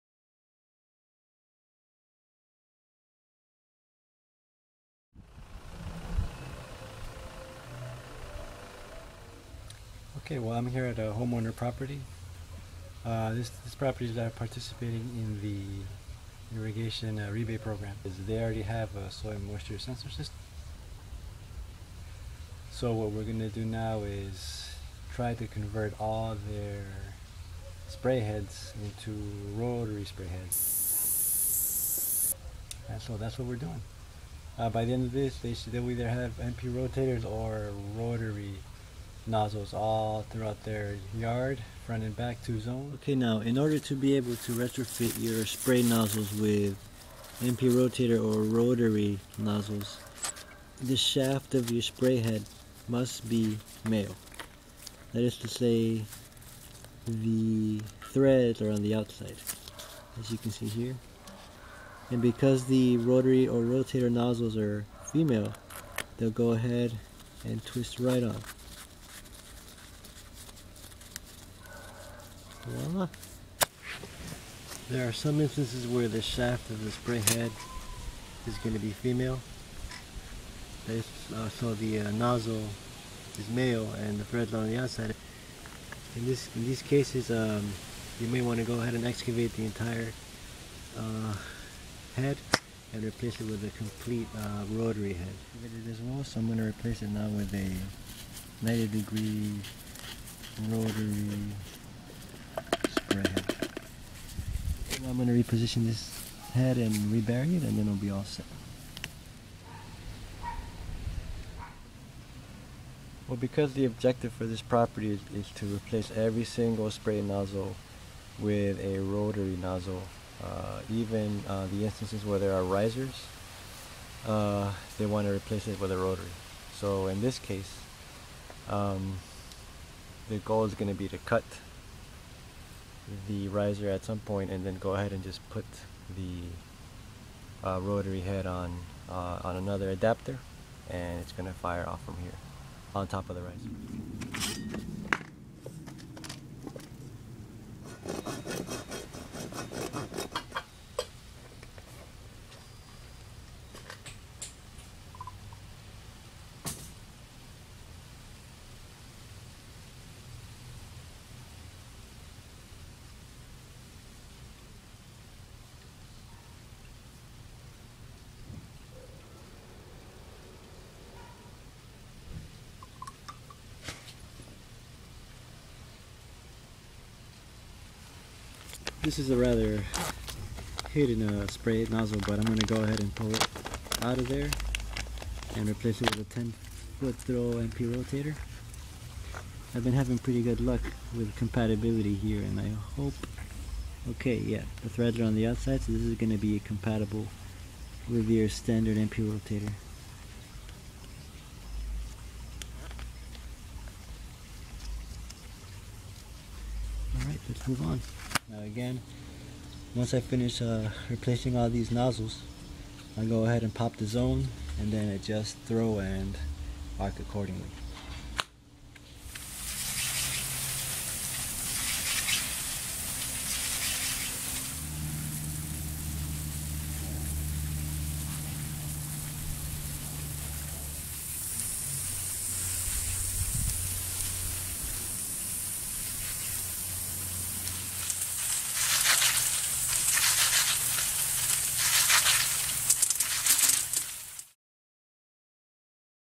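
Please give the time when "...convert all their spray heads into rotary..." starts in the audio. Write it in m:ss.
0:25.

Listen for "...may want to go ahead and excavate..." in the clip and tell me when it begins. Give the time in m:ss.
1:28.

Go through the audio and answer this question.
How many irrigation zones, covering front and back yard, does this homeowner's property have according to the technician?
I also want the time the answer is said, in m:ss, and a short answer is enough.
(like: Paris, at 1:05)
2, at 0:42.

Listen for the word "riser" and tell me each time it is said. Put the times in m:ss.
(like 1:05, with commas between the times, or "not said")
2:02, 2:13, 2:23.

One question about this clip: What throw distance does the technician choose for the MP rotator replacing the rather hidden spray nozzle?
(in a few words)
10 foot.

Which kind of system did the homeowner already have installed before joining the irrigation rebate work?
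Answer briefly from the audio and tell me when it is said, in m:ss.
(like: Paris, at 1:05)
soil moisture sensor, at 0:19.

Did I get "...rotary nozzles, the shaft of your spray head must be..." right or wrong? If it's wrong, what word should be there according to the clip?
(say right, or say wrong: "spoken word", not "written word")
right.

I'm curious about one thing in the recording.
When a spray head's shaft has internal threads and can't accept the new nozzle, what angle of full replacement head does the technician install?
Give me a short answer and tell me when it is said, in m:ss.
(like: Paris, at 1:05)
90 degree, at 1:38.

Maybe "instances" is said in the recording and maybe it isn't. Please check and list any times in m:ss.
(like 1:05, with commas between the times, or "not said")
1:15, 2:01.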